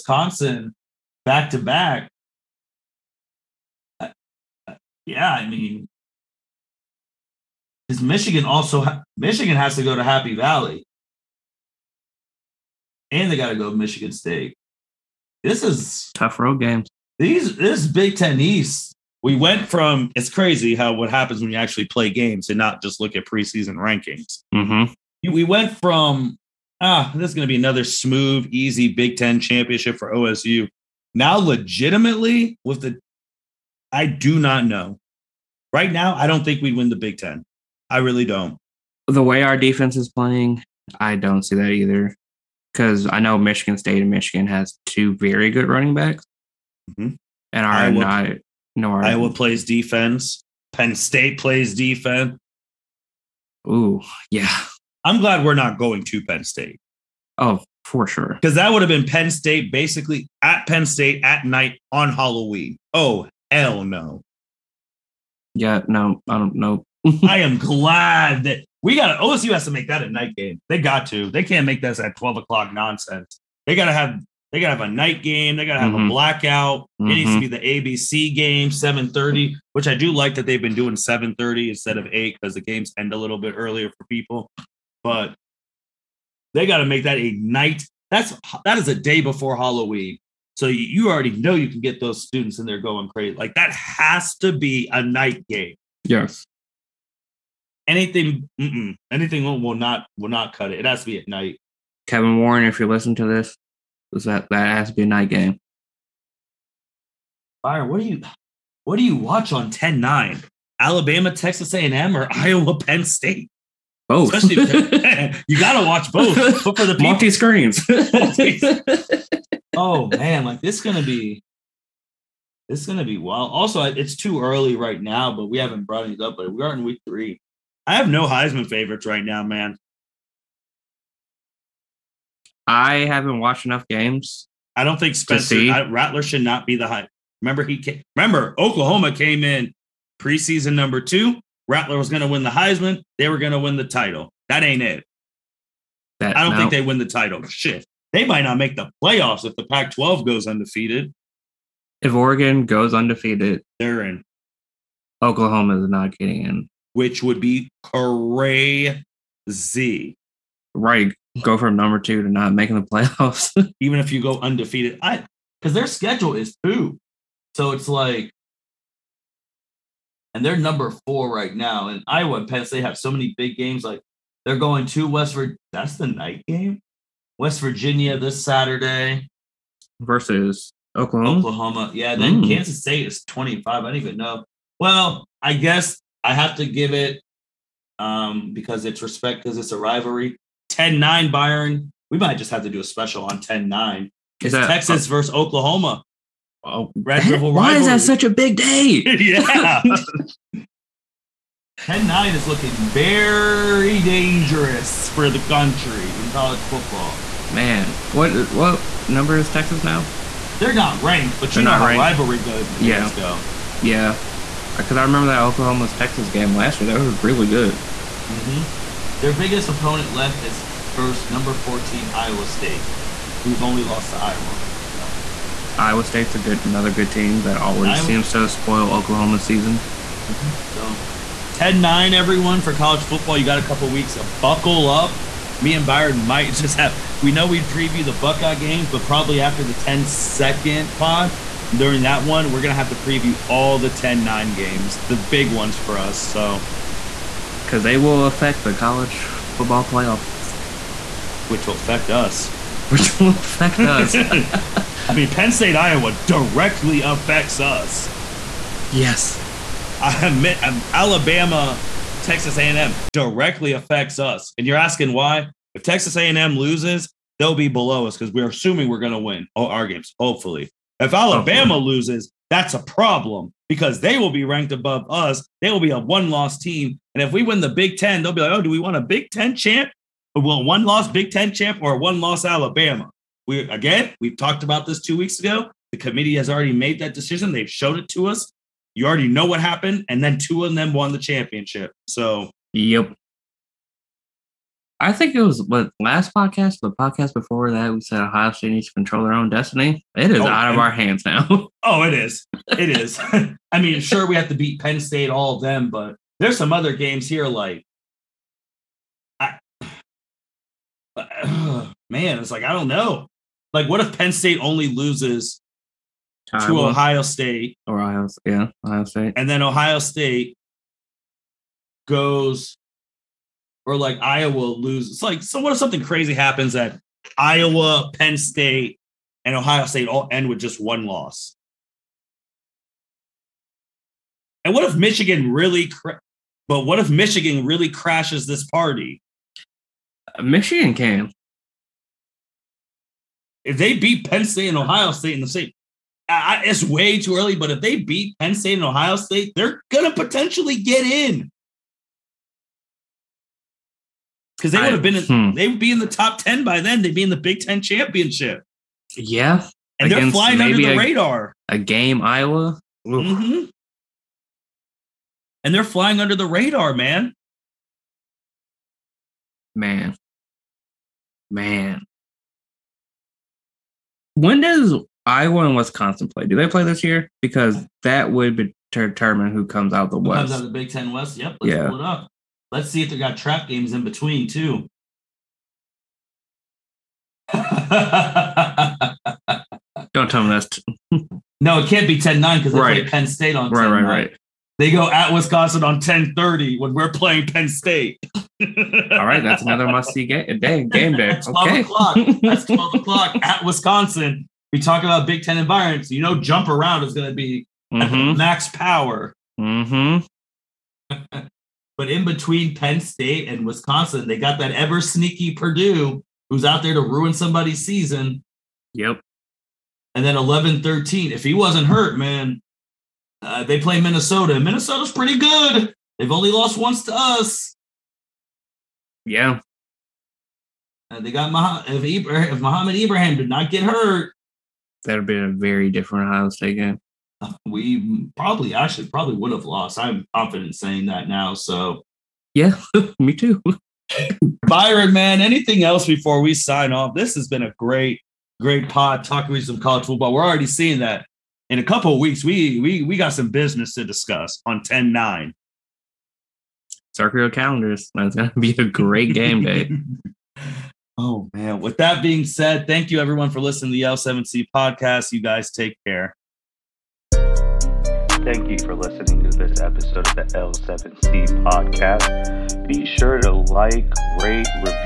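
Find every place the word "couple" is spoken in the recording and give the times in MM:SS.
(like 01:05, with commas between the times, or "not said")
03:53, 07:31.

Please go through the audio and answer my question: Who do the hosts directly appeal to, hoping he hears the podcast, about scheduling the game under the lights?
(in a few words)
Kevin Warren.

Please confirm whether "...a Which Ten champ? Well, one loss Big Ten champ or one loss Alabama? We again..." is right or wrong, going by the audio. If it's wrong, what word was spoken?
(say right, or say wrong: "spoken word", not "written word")
wrong: "Big", not "Which".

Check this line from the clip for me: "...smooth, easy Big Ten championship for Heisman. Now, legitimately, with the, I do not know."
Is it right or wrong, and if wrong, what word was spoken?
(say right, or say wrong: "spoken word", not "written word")
wrong: "OSU", not "Heisman".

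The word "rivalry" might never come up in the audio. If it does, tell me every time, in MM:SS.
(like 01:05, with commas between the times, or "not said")
03:09, 03:17, 03:31.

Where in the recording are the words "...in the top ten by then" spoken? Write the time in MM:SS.
05:55.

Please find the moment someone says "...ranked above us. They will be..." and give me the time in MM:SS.
04:34.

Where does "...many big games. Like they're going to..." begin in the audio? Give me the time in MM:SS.
02:53.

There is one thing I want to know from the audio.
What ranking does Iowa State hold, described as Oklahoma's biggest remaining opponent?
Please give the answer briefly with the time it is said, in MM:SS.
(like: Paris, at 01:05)
14, at 03:41.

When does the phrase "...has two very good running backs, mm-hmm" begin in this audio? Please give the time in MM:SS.
00:44.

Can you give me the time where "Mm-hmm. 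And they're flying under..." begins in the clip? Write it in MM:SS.
06:03.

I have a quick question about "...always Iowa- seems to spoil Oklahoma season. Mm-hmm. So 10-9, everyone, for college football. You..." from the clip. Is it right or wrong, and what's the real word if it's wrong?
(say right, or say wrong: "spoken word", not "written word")
right.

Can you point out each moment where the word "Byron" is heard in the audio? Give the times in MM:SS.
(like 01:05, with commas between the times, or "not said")
01:47, 03:11, 03:55, 07:24.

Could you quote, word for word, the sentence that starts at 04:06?
So, because they will affect the college football playoffs, which will affect us.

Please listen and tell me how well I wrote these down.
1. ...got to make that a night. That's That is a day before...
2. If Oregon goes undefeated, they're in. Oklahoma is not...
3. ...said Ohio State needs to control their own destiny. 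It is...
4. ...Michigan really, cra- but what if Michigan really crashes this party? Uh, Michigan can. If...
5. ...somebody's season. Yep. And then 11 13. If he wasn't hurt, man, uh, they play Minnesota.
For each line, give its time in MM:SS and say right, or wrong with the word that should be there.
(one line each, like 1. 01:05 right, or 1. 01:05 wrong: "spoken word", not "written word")
1. 01:26 right
2. 02:31 right
3. 04:58 right
4. 05:34 right
5. 06:57 right.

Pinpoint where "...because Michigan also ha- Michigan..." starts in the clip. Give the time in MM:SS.
00:07.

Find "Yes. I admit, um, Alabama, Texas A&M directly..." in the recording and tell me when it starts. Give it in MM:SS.
04:18.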